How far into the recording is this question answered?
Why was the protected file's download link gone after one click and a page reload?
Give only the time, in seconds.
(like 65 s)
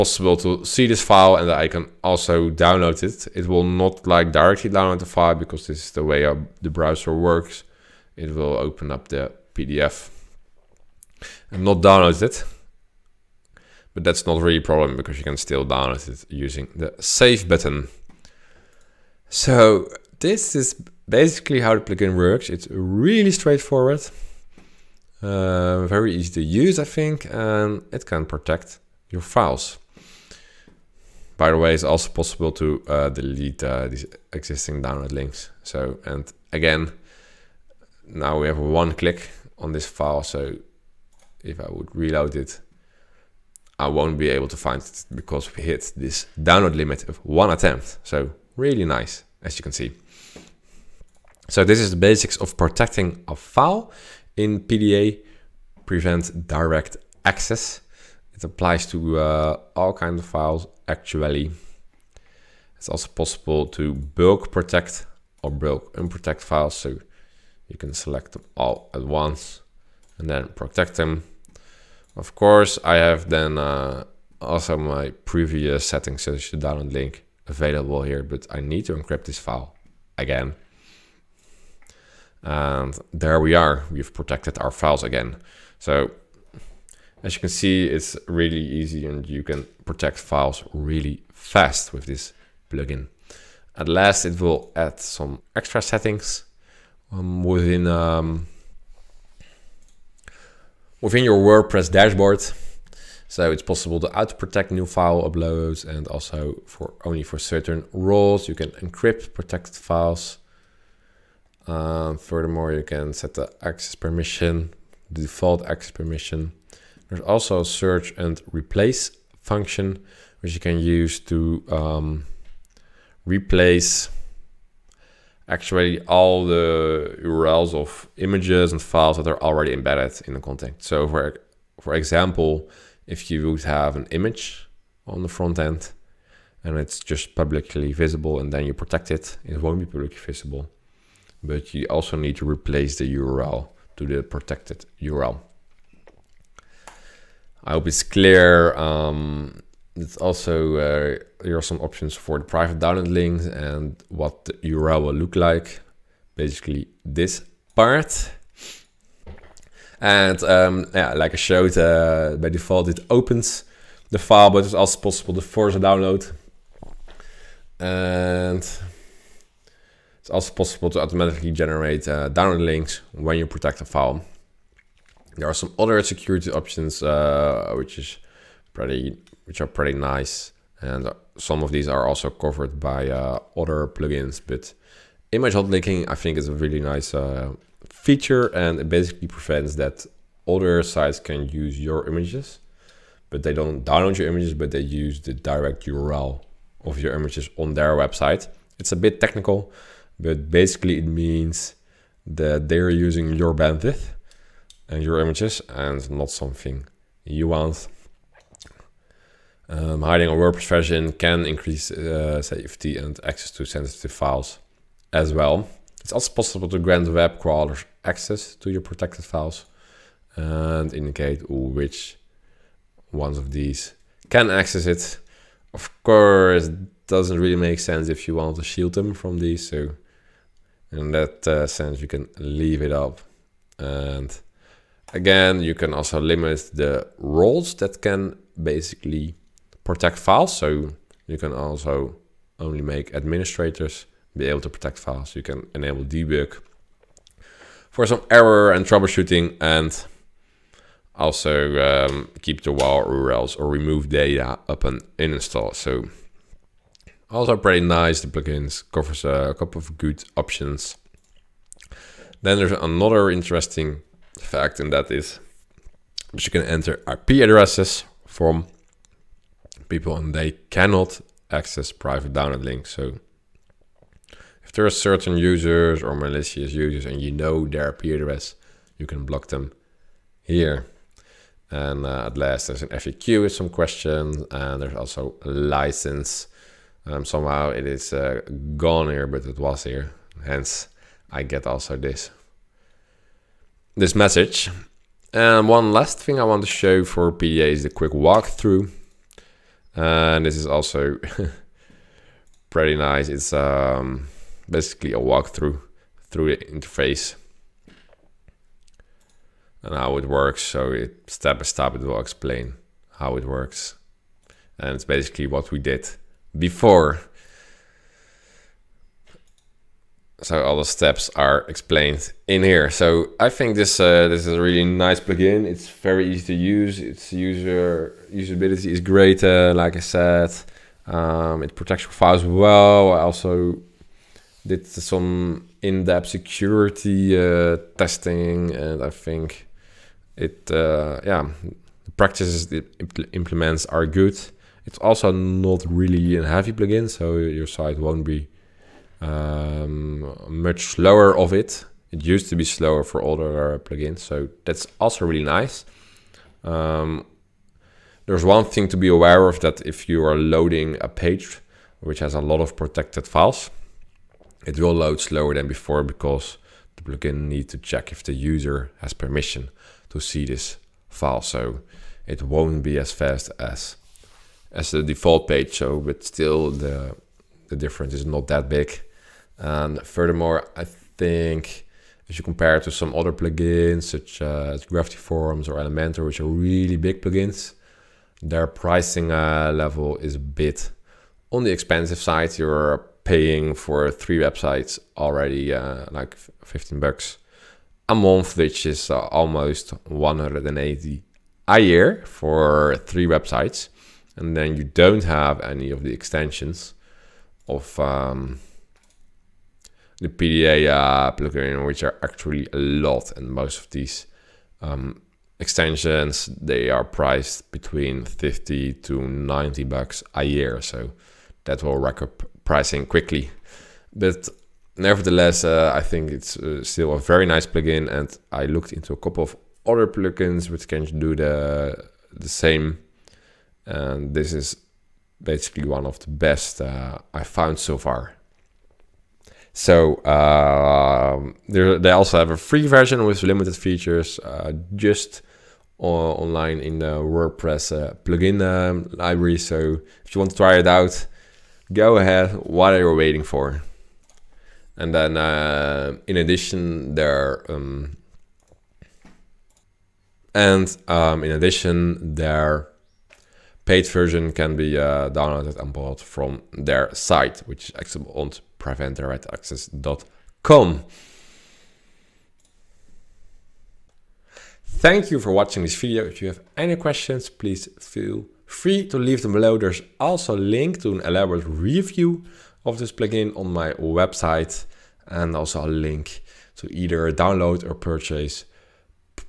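46 s.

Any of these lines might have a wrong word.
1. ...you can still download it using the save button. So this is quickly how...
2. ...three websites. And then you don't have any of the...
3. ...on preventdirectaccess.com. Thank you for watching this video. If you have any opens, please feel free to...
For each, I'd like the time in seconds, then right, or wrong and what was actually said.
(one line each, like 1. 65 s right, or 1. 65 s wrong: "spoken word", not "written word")
1. 15 s wrong: "basically", not "quickly"
2. 403 s right
3. 468 s wrong: "questions", not "opens".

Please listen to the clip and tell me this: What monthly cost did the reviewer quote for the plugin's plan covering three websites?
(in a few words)
15 bucks.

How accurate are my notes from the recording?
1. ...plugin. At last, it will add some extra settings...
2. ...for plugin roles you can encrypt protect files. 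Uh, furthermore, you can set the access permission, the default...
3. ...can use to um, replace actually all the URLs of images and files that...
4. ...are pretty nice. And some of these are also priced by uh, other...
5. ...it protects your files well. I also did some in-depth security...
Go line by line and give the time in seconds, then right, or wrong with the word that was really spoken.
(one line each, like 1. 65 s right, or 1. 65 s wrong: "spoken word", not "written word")
1. 92 s right
2. 107 s wrong: "certain", not "plugin"
3. 120 s right
4. 179 s wrong: "covered", not "priced"
5. 331 s right.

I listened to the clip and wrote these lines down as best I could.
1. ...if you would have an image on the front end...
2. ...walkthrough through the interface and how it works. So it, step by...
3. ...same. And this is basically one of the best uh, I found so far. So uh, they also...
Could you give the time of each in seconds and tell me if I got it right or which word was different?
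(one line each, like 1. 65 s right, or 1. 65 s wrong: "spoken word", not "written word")
1. 133 s right
2. 305 s right
3. 432 s right.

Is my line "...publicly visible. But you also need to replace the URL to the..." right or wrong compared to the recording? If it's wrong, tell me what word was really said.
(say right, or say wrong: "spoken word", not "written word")
right.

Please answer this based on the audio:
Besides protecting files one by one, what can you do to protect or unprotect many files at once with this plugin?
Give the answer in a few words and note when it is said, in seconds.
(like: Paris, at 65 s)
bulk protect, at 63 s.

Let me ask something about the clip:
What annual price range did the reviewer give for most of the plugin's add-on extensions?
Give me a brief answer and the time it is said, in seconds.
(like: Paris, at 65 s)
50 to 90 bucks, at 418 s.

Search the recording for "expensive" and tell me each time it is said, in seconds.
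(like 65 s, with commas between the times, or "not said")
391 s.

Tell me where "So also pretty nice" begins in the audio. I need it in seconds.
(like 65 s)
255 s.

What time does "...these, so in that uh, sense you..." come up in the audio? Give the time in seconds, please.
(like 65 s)
229 s.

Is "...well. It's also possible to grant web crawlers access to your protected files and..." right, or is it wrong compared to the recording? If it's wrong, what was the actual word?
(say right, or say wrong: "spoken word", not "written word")
right.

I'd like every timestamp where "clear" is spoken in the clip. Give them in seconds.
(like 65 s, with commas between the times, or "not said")
148 s.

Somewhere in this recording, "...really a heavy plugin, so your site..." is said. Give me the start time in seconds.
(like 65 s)
345 s.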